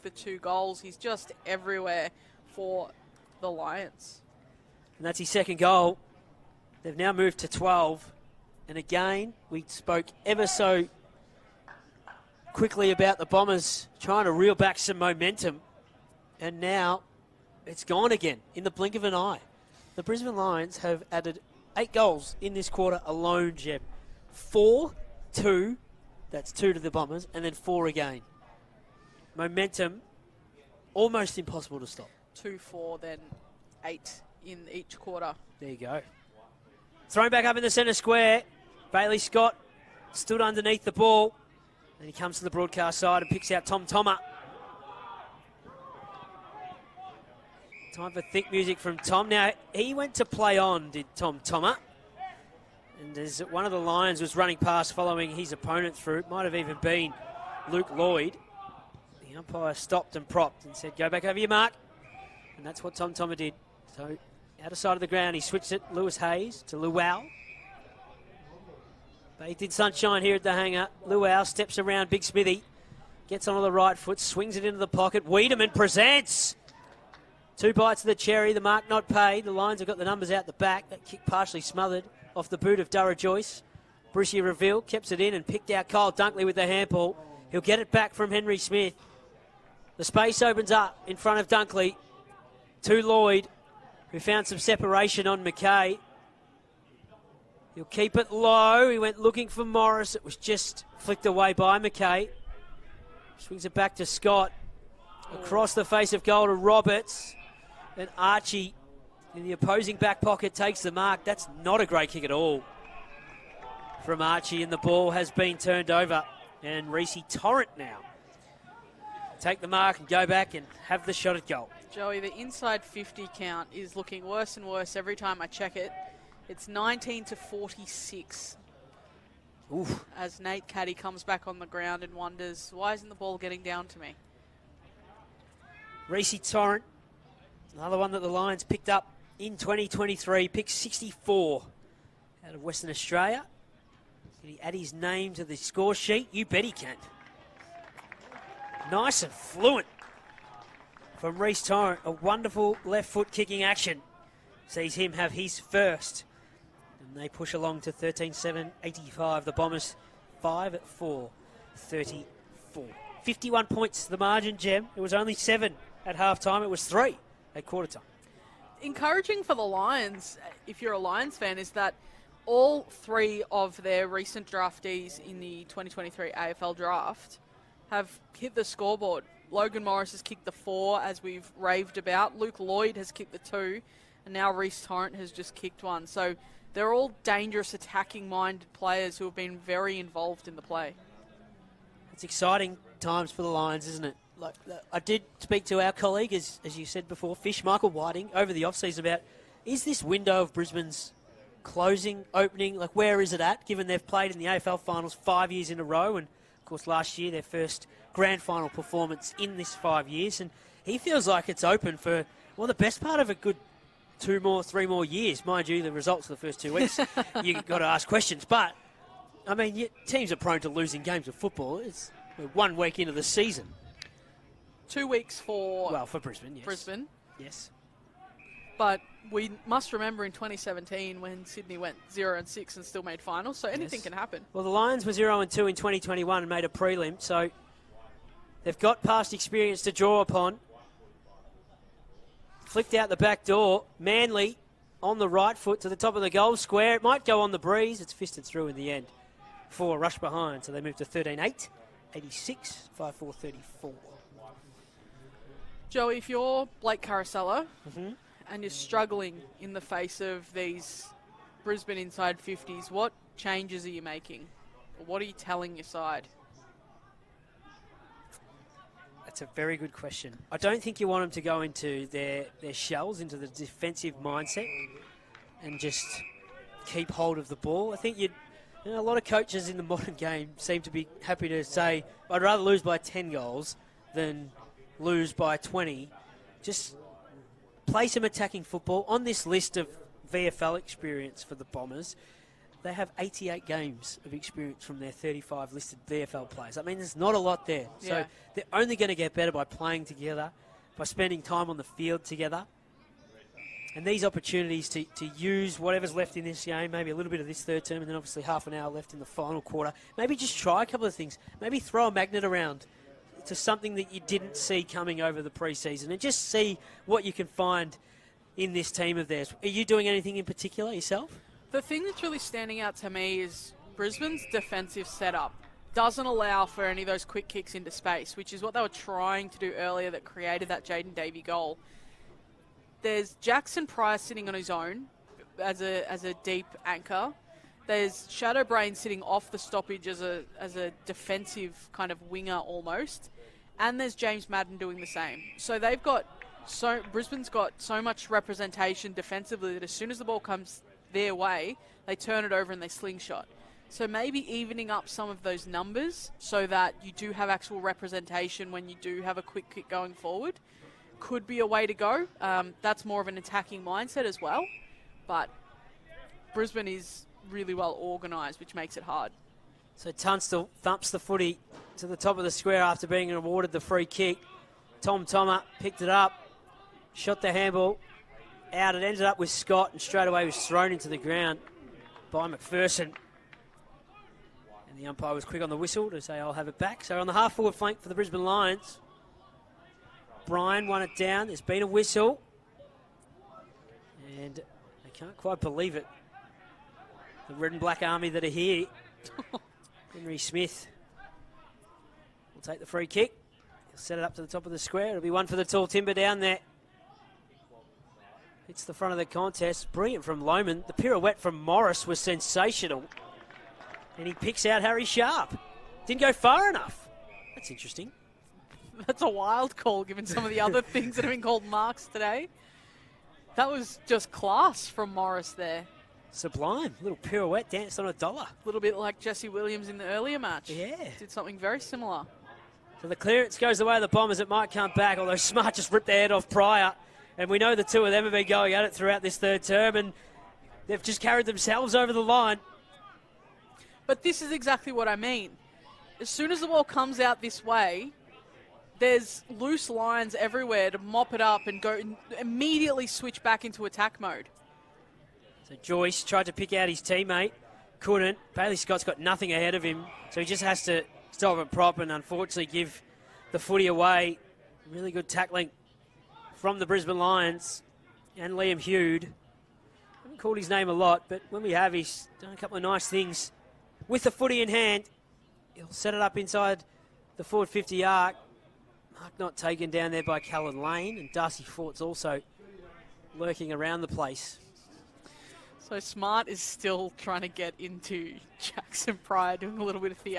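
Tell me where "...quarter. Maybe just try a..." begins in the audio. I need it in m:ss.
5:09.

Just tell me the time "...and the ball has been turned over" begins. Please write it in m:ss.
1:54.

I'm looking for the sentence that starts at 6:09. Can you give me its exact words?
So Tunstall thumps the footy to the top of the square after being awarded the free kick.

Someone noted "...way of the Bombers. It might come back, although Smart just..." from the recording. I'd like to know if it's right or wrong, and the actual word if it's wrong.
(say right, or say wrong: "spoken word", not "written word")
right.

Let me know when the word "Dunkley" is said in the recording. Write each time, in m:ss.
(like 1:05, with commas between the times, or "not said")
1:26, 1:31.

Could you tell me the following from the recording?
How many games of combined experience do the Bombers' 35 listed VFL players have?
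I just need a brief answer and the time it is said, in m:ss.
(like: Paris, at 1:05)
88, at 4:53.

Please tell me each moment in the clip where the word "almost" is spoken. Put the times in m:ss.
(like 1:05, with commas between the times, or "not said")
0:30, 5:42.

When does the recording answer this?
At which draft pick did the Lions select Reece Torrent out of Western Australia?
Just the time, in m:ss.
2:20.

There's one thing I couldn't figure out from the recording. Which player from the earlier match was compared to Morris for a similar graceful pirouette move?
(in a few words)
Jesse Williams.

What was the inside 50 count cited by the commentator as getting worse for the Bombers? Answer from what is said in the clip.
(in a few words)
19 to 46.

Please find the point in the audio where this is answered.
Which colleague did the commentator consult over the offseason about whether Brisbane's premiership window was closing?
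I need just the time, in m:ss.
3:17.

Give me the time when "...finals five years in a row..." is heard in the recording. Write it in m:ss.
3:24.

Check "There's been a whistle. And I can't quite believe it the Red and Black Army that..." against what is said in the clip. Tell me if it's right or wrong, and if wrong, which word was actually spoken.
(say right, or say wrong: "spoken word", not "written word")
right.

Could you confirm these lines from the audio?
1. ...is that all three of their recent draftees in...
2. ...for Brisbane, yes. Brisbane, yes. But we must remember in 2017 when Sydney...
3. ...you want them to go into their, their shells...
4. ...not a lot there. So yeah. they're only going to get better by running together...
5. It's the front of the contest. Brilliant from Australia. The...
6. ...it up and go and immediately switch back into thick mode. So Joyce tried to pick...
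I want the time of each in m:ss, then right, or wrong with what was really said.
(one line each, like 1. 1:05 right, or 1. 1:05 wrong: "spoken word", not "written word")
1. 2:51 right
2. 3:46 right
3. 4:31 right
4. 4:57 wrong: "playing", not "running"
5. 6:48 wrong: "Lohmann", not "Australia"
6. 7:31 wrong: "attack", not "thick".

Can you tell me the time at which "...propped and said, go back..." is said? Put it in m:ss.
1:00.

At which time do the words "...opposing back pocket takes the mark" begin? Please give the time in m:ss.
1:49.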